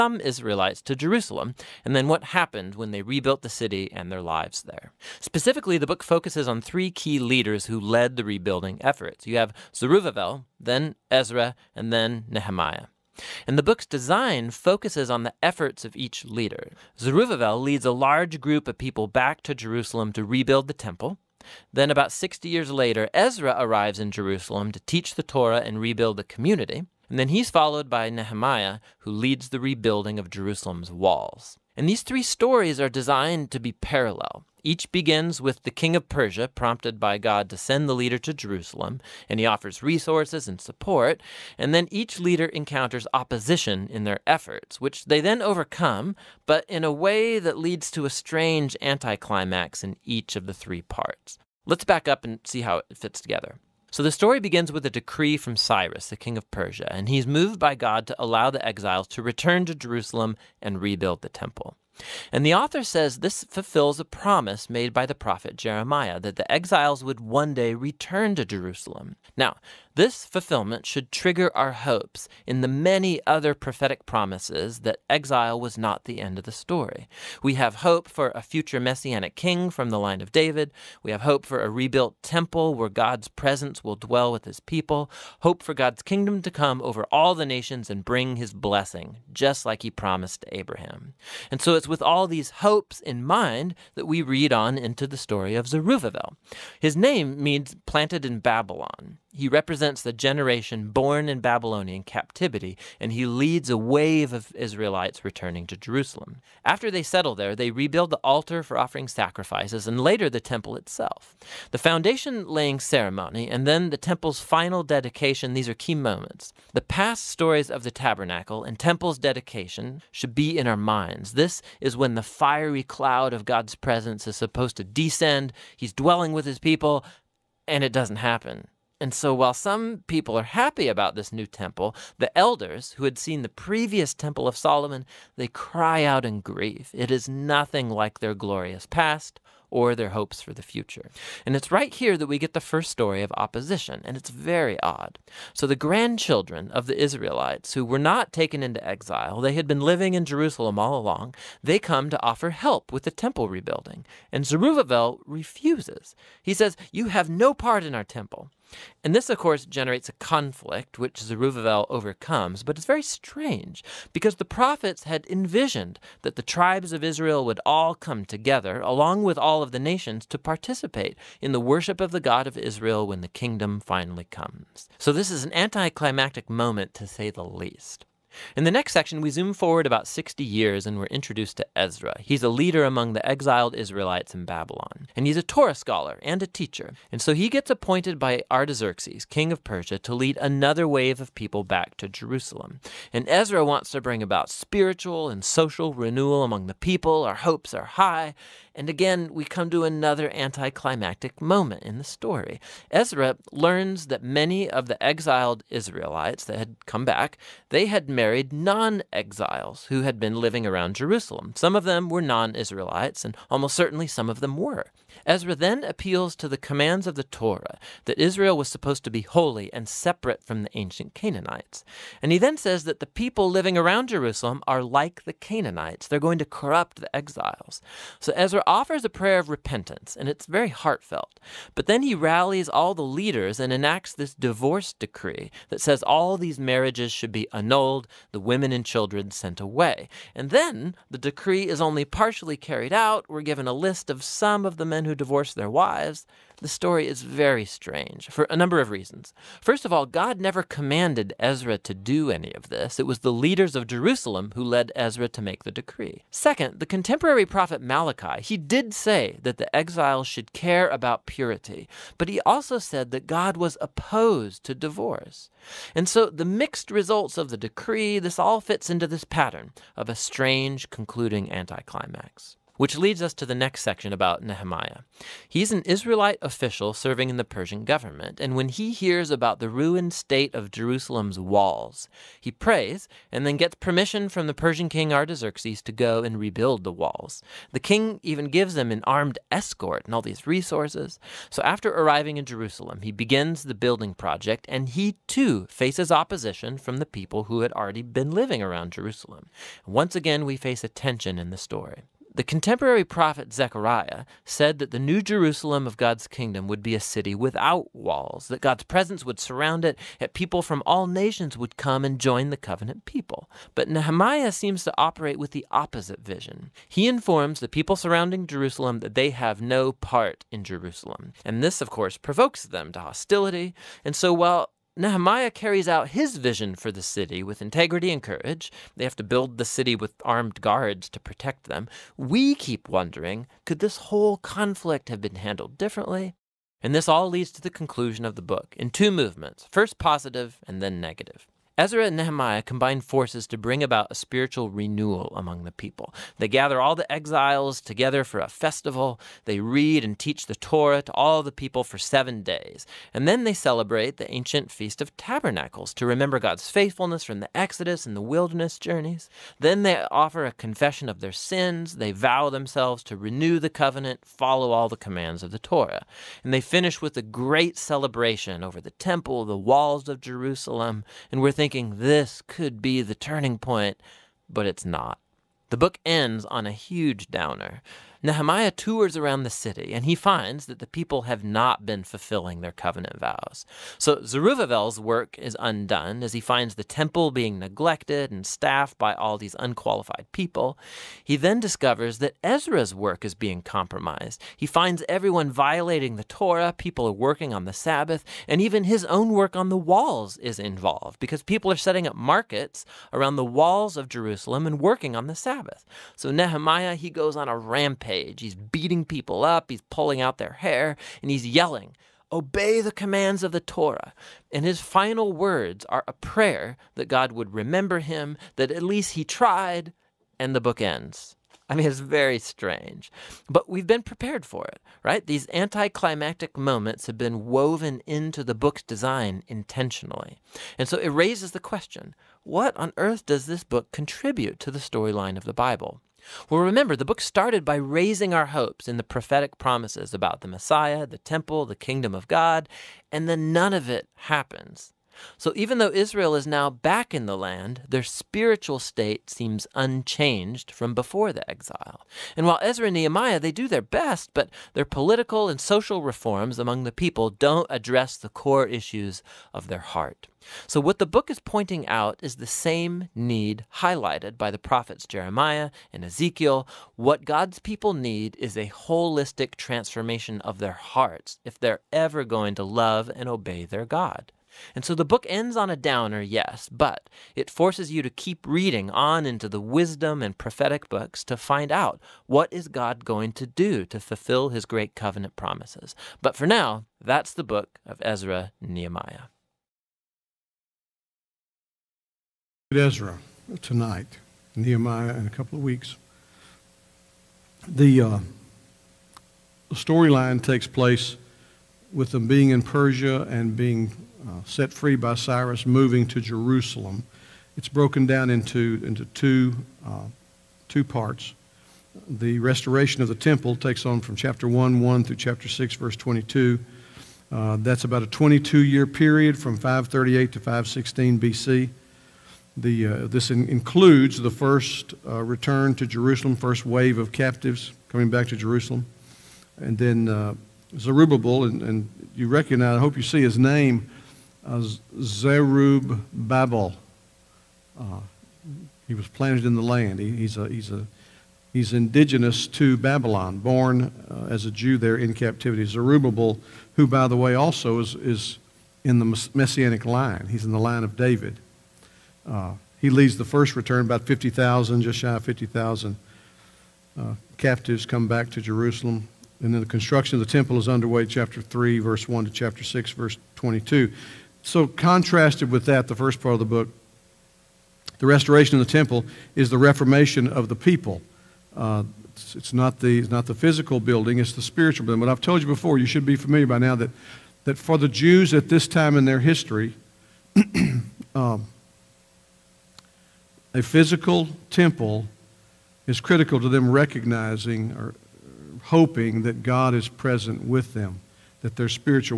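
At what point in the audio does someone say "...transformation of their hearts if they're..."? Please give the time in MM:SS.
07:49.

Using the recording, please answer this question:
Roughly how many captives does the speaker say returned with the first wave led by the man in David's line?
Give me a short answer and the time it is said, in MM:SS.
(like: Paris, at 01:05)
Just shy of 50,000, at 09:14.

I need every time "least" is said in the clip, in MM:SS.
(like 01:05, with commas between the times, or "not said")
02:57, 06:58.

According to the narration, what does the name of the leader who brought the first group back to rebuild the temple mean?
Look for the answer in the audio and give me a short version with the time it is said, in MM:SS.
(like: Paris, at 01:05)
Planted in Babylon, at 01:37.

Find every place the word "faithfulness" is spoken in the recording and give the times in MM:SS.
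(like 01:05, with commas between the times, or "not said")
05:56.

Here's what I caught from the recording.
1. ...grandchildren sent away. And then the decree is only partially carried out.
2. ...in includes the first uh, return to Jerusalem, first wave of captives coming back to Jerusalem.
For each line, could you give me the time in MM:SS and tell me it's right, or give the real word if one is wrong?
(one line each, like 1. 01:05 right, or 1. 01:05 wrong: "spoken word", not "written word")
1. 03:58 wrong: "children", not "grandchildren"
2. 08:43 right.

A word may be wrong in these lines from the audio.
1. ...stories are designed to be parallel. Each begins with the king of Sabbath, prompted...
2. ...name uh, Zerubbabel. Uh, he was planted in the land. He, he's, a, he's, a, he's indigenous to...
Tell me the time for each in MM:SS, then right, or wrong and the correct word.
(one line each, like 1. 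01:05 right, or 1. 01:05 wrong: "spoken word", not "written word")
1. 00:32 wrong: "Persia", not "Sabbath"
2. 08:53 right.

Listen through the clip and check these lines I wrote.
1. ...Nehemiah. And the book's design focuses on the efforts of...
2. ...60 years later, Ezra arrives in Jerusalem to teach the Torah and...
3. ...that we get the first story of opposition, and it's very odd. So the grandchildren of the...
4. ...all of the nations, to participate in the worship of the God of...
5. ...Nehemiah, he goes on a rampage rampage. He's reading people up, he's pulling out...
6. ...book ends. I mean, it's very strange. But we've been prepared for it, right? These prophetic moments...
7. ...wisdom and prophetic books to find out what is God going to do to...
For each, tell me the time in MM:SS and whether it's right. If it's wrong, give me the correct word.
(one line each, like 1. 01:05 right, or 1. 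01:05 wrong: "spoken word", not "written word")
1. 00:12 right
2. 00:22 right
3. 02:22 right
4. 02:49 right
5. 06:46 wrong: "beating", not "reading"
6. 07:00 wrong: "anticlimactic", not "prophetic"
7. 07:59 right.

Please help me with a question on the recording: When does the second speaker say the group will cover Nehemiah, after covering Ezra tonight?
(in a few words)
In a couple of weeks.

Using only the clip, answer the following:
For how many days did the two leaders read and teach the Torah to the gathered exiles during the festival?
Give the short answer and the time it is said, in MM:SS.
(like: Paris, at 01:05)
7, at 05:51.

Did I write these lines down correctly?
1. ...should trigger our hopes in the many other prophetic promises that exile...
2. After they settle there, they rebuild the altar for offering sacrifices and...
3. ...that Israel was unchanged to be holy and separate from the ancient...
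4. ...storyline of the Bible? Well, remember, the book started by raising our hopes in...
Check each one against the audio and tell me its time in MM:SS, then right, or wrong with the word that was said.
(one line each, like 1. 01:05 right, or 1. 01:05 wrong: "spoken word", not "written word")
1. 01:10 right
2. 01:46 right
3. 03:38 wrong: "supposed", not "unchanged"
4. 07:14 right.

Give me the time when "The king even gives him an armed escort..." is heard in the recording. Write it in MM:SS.
04:47.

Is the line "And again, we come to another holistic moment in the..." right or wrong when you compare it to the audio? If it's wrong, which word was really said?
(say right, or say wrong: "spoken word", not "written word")
wrong: "anticlimactic", not "holistic".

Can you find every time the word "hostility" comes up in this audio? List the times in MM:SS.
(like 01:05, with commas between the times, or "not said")
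05:22.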